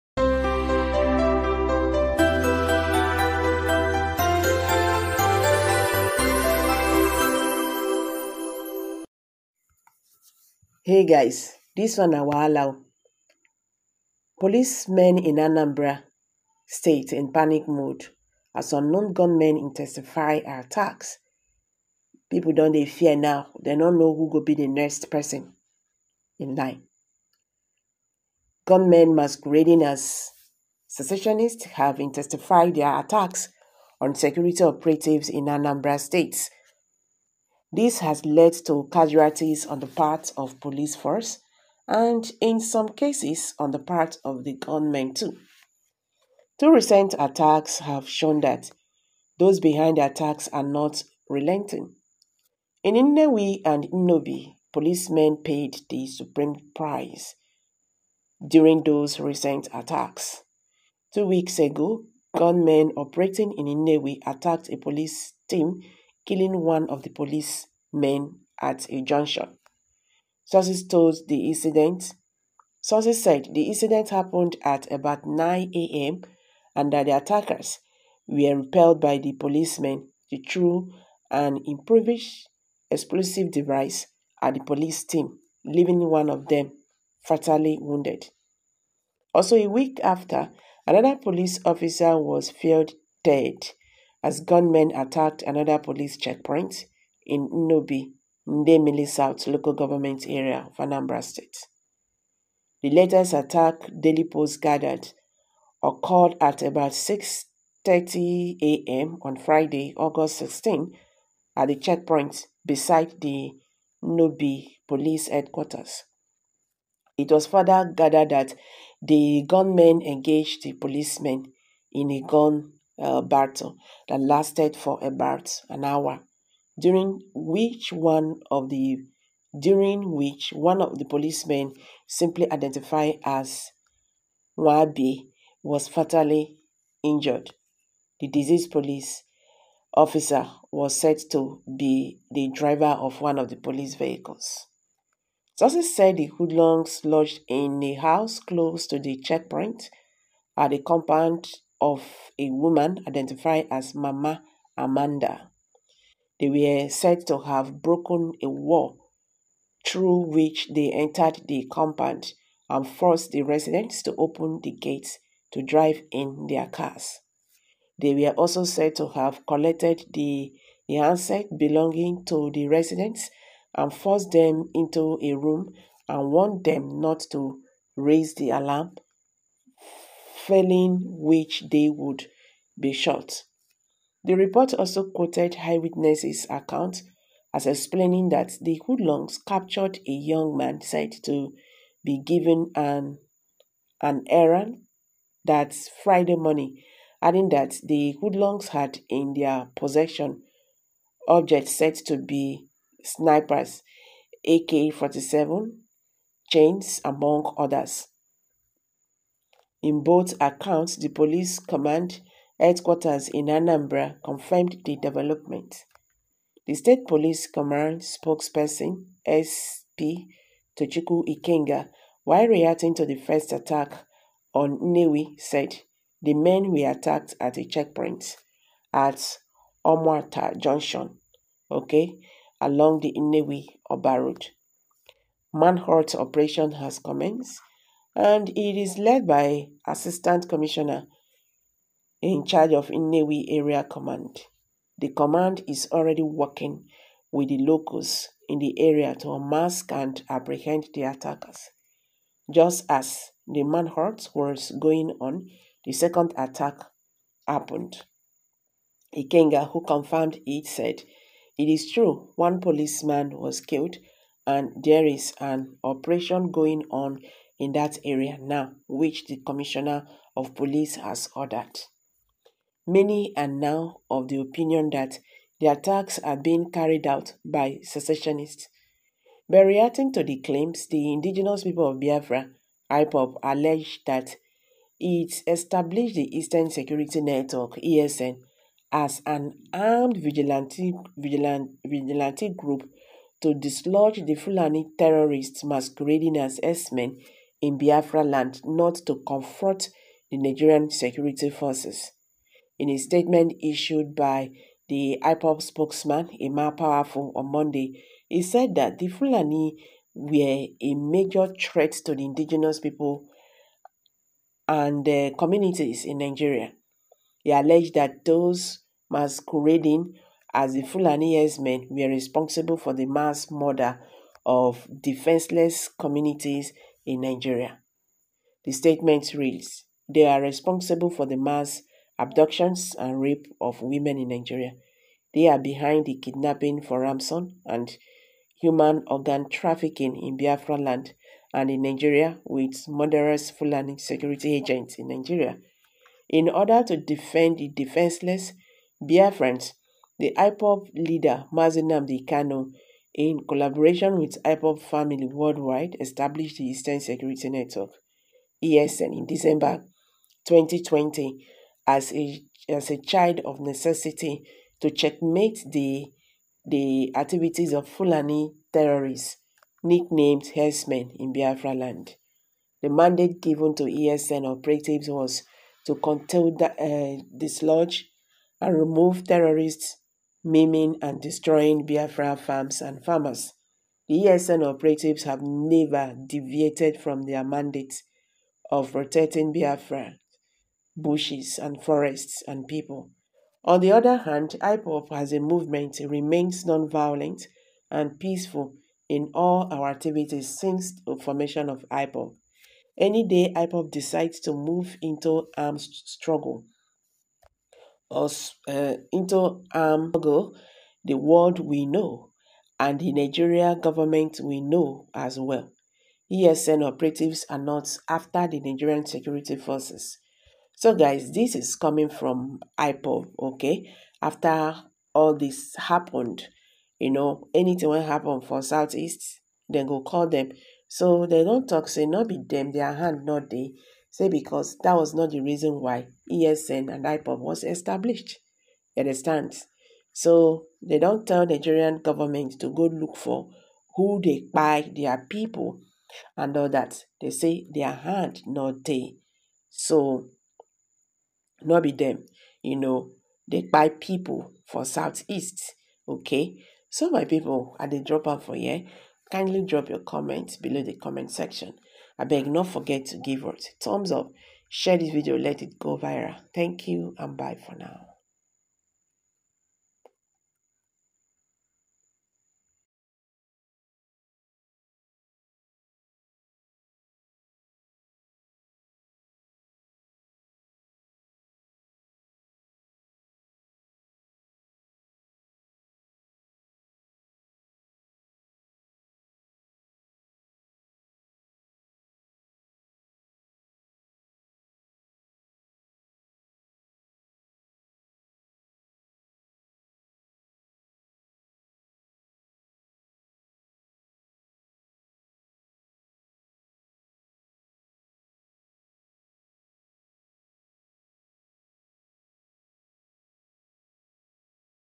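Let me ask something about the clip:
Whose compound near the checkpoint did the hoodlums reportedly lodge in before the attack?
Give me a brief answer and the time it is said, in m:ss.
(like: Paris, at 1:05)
Mama Amanda, at 2:33.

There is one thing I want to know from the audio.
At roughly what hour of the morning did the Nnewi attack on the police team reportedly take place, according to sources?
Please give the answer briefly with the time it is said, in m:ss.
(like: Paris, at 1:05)
9 a.m., at 1:15.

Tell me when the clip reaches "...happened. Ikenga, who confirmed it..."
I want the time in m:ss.
4:17.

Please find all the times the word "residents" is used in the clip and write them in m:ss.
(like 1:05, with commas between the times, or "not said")
2:43, 2:52.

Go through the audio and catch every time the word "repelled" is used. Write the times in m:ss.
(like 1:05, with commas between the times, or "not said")
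1:18.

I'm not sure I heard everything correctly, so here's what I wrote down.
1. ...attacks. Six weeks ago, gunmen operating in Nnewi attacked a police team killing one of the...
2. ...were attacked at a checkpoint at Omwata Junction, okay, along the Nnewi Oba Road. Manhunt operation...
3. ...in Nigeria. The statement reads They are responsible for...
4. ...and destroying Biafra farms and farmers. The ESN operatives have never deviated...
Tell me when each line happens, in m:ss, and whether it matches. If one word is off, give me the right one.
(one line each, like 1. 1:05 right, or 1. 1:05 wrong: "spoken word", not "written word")
1. 0:59 wrong: "Two", not "Six"
2. 3:46 right
3. 5:27 right
4. 6:21 right.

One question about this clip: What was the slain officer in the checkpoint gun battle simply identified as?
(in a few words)
Wabi.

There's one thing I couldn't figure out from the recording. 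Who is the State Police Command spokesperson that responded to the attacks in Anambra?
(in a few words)
SP Tochukwu Ikenga.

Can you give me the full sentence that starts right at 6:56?
ESN operatives are not after the Nigerian security forces.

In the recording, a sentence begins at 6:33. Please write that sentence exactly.
On the other hand, IPOB as a movement remains non-violent and peaceful in all our activities since the formation of IPOB.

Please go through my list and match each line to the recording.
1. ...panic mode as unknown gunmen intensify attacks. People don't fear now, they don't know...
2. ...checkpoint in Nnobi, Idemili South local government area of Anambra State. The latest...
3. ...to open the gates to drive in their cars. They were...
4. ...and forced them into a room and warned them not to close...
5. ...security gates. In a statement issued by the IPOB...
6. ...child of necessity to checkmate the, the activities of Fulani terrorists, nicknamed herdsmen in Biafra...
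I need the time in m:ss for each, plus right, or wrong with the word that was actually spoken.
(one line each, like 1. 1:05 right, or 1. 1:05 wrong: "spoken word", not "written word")
1. 0:17 right
2. 1:36 right
3. 2:44 right
4. 2:53 wrong: "raise", not "close"
5. 5:00 wrong: "forces", not "gates"
6. 6:03 right.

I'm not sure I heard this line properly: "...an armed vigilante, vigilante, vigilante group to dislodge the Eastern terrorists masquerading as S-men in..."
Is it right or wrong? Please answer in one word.
wrong.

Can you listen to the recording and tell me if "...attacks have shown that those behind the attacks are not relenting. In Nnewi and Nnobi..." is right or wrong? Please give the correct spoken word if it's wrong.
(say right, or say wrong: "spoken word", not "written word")
right.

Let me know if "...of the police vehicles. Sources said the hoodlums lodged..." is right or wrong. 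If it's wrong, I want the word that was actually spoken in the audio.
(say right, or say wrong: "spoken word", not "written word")
right.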